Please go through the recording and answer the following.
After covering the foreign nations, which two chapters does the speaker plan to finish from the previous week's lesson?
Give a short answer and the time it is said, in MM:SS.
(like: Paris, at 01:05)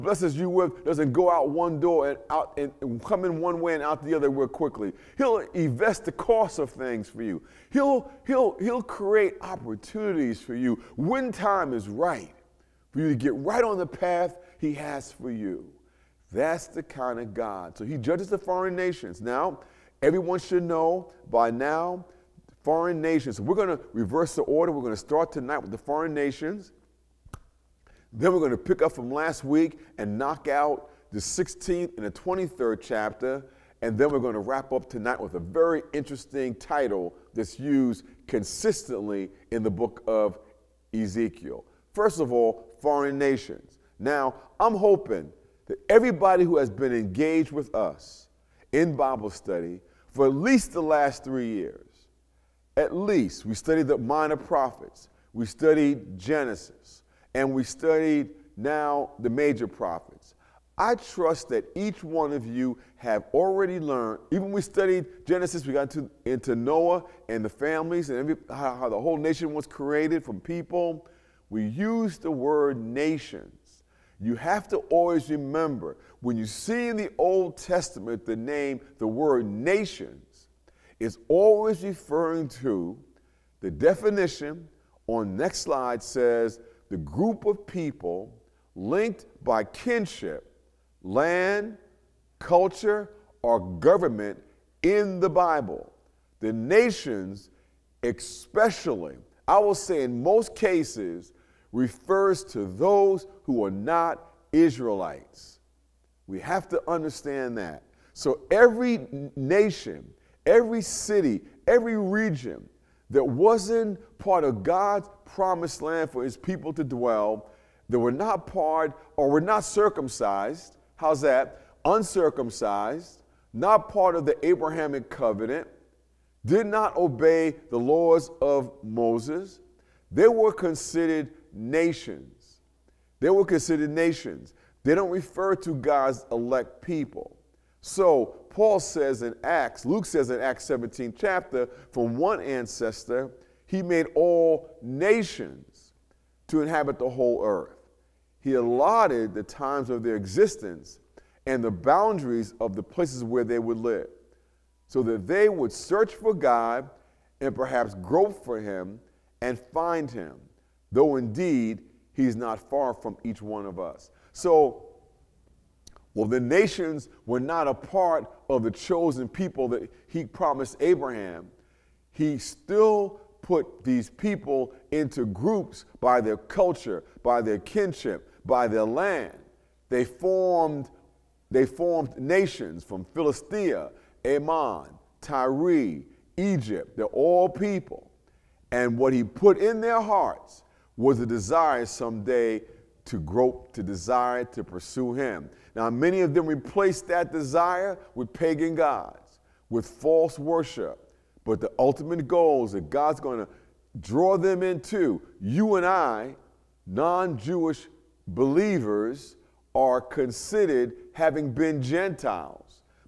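16th and 23rd, at 00:31.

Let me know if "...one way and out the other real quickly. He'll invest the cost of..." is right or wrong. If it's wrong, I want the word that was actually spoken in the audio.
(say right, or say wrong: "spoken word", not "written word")
right.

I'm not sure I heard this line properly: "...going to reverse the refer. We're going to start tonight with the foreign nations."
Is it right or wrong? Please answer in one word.
wrong.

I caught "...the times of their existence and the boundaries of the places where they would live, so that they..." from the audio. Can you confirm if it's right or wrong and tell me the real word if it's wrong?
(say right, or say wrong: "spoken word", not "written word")
right.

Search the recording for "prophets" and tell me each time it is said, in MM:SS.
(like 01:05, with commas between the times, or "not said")
00:54, 00:59.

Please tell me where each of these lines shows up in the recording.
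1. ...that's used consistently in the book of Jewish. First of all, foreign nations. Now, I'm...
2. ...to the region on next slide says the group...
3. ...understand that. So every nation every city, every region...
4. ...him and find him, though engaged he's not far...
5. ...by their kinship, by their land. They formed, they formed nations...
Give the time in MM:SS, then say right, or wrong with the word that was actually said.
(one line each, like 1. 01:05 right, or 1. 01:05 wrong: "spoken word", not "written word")
1. 00:37 wrong: "Ezekiel", not "Jewish"
2. 01:22 wrong: "definition", not "region"
3. 01:46 right
4. 02:38 wrong: "indeed", not "engaged"
5. 02:57 right.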